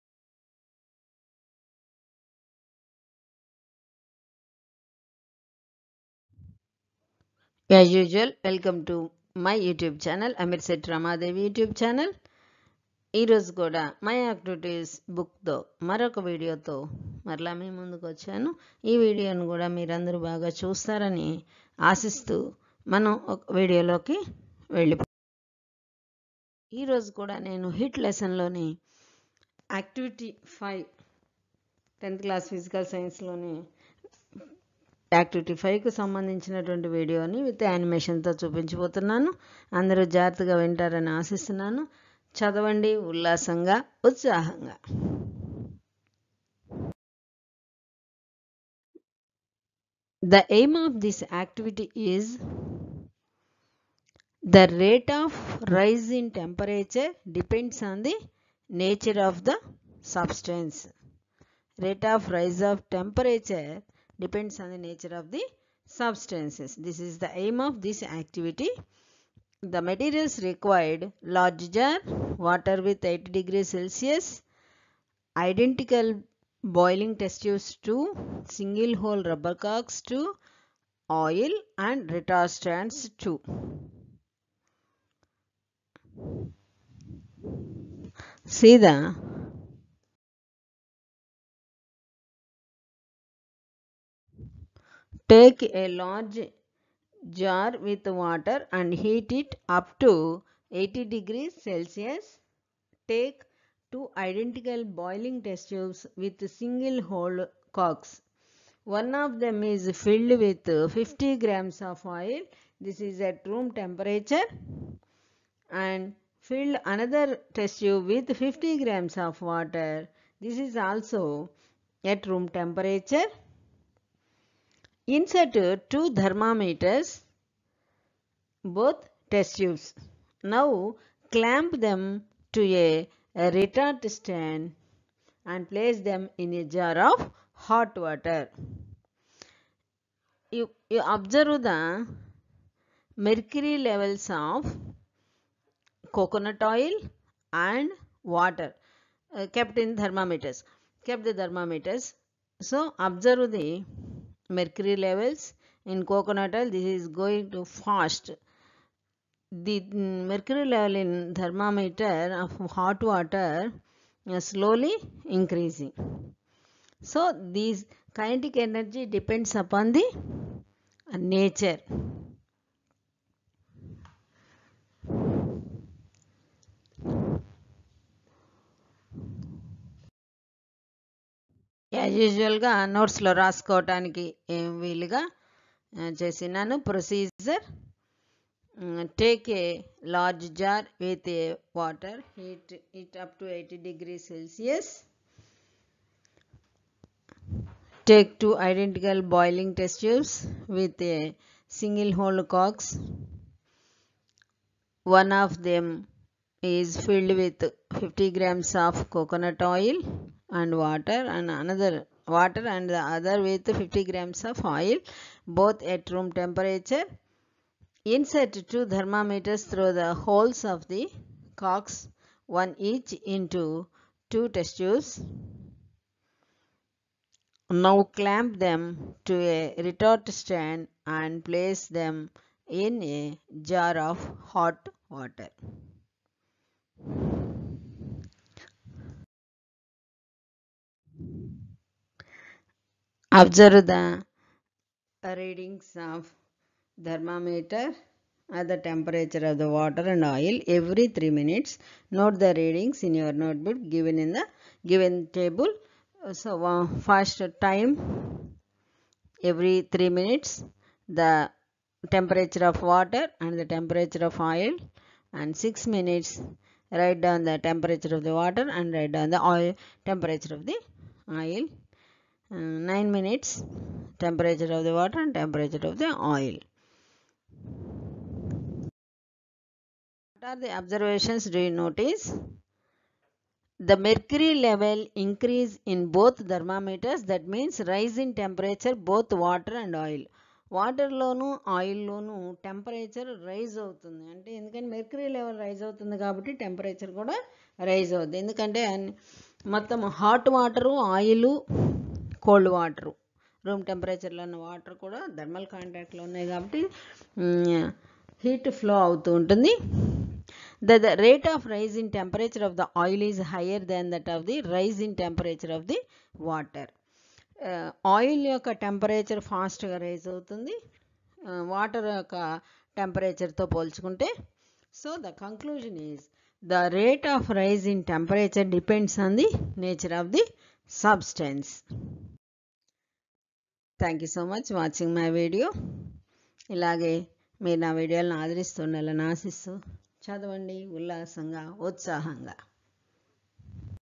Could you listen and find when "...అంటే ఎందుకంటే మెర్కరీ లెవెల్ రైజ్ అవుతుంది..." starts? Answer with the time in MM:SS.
04:54.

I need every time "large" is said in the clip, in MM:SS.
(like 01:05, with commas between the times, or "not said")
01:11, 01:35.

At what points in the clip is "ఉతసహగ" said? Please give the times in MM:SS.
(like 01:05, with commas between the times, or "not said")
00:44, 05:41.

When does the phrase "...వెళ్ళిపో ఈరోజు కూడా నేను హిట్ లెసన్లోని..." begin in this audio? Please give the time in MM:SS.
00:24.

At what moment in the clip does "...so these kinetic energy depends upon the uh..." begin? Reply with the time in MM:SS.
02:47.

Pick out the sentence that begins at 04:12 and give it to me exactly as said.
Note the readings in your notebook given in the given table.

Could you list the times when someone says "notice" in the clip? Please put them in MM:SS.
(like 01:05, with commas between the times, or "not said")
04:41.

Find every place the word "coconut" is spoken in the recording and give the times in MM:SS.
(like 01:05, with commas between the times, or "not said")
02:26, 02:36.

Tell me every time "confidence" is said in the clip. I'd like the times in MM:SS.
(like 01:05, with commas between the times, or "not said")
not said.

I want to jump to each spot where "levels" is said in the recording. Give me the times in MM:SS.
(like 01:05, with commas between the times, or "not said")
02:23, 02:35, 02:40, 04:44.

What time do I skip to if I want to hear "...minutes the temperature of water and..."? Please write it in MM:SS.
04:20.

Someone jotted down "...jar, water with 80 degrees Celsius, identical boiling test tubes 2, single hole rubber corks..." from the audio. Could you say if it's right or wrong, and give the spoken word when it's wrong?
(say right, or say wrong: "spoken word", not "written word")
right.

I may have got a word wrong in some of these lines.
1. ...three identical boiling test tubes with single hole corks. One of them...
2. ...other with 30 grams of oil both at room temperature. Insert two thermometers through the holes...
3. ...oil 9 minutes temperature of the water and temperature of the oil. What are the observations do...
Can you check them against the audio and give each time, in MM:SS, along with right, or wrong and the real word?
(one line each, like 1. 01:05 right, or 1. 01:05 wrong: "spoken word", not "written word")
1. 01:43 wrong: "two", not "three"
2. 03:33 wrong: "50", not "30"
3. 04:31 right.